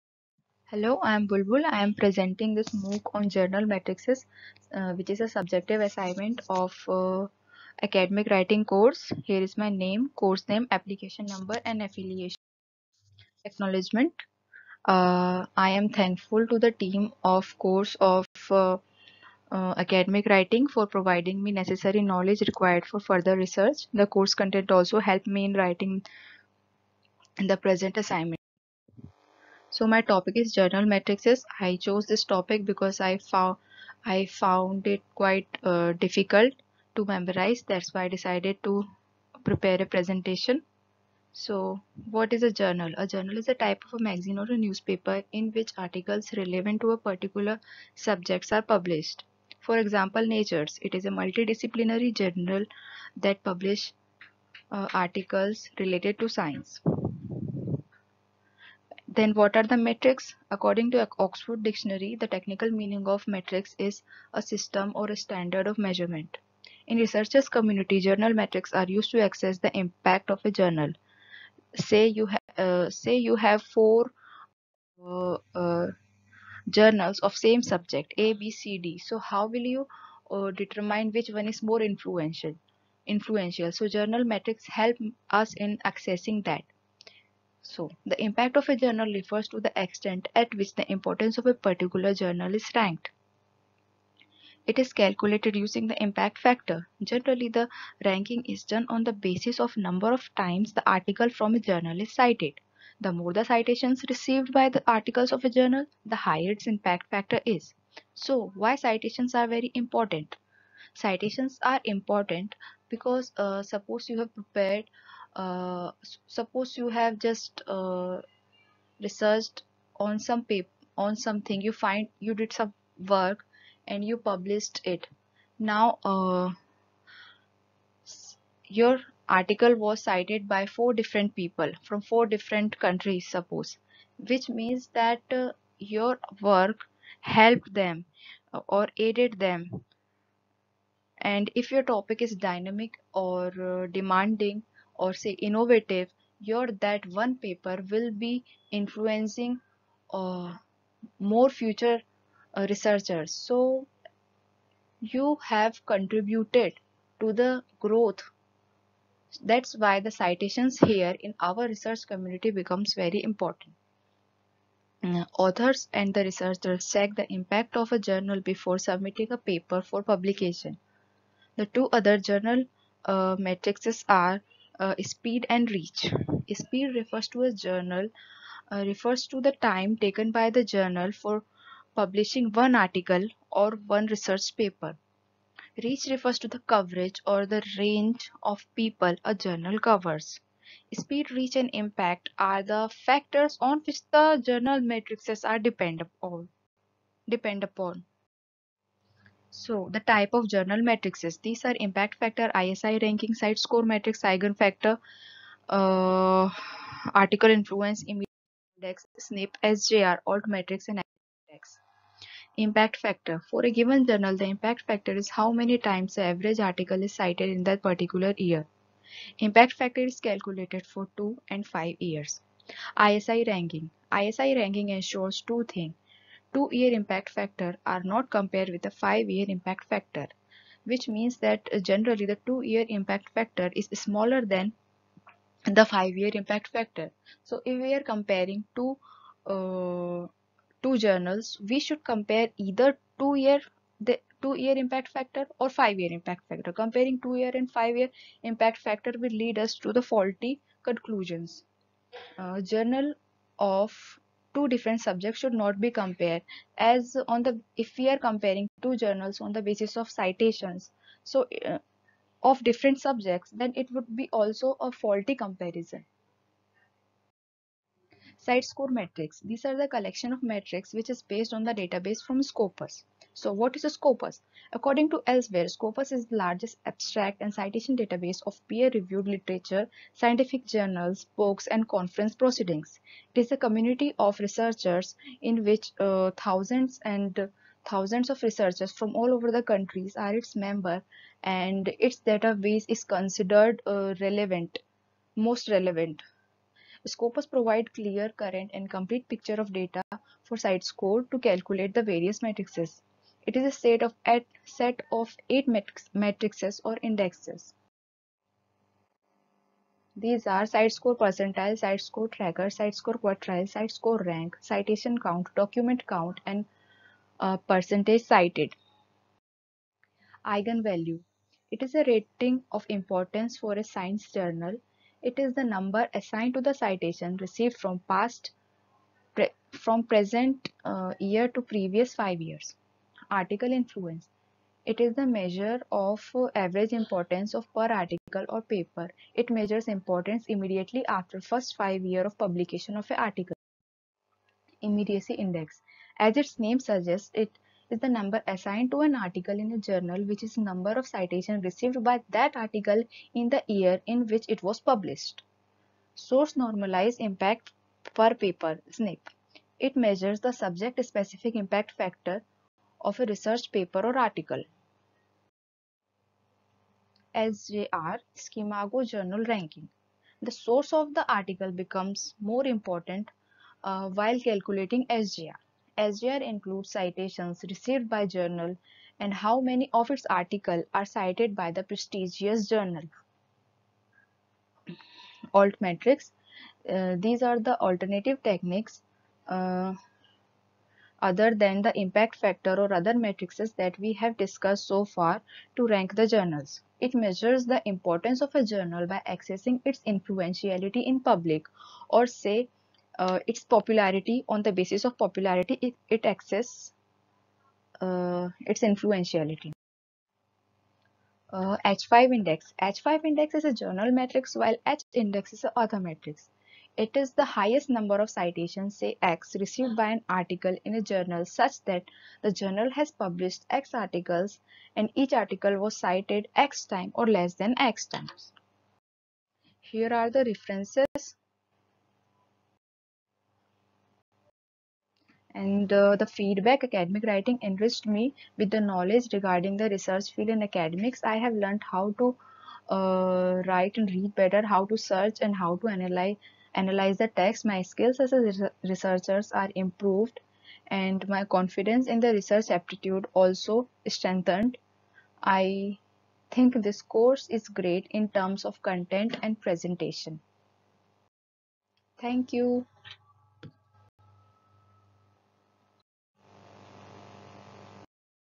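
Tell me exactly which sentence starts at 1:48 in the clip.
So, why citations are very important?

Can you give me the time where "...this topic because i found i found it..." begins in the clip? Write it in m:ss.
0:32.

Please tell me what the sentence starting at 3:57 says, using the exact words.
So if we are comparing two uh, two journals, we should compare either two-year the two-year impact factor or five-year impact factor.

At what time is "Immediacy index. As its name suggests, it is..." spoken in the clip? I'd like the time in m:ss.
5:44.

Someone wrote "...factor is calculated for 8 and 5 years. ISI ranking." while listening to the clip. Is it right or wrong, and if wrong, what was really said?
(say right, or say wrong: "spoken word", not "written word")
wrong: "2", not "8".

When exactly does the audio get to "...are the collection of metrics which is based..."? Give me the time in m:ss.
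4:29.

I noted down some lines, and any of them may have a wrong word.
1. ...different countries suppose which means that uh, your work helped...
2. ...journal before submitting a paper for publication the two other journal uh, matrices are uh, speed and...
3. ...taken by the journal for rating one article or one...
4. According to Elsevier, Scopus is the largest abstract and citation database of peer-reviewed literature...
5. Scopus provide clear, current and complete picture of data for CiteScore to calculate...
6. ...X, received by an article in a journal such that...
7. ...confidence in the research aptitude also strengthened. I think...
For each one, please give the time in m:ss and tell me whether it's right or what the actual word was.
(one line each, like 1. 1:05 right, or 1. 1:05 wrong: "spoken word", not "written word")
1. 2:12 right
2. 2:48 right
3. 2:59 wrong: "publishing", not "rating"
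4. 4:34 right
5. 4:57 right
6. 6:59 right
7. 7:31 right.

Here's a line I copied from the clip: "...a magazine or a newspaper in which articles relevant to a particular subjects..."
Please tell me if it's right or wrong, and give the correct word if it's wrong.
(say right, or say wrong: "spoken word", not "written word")
right.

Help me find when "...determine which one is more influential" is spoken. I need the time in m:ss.
1:20.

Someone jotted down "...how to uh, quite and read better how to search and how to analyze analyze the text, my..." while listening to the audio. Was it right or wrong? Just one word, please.
wrong.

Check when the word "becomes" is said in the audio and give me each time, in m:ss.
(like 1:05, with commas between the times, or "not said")
2:42, 6:11.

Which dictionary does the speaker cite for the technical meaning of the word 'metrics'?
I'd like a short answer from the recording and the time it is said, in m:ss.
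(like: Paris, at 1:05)
Oxford Dictionary, at 1:01.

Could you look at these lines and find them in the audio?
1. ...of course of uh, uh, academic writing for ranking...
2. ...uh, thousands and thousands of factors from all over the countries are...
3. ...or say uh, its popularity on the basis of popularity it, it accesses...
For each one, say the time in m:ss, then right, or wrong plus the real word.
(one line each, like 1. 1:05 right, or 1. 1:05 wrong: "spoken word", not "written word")
1. 0:17 wrong: "providing", not "ranking"
2. 4:45 wrong: "researchers", not "factors"
3. 6:42 right.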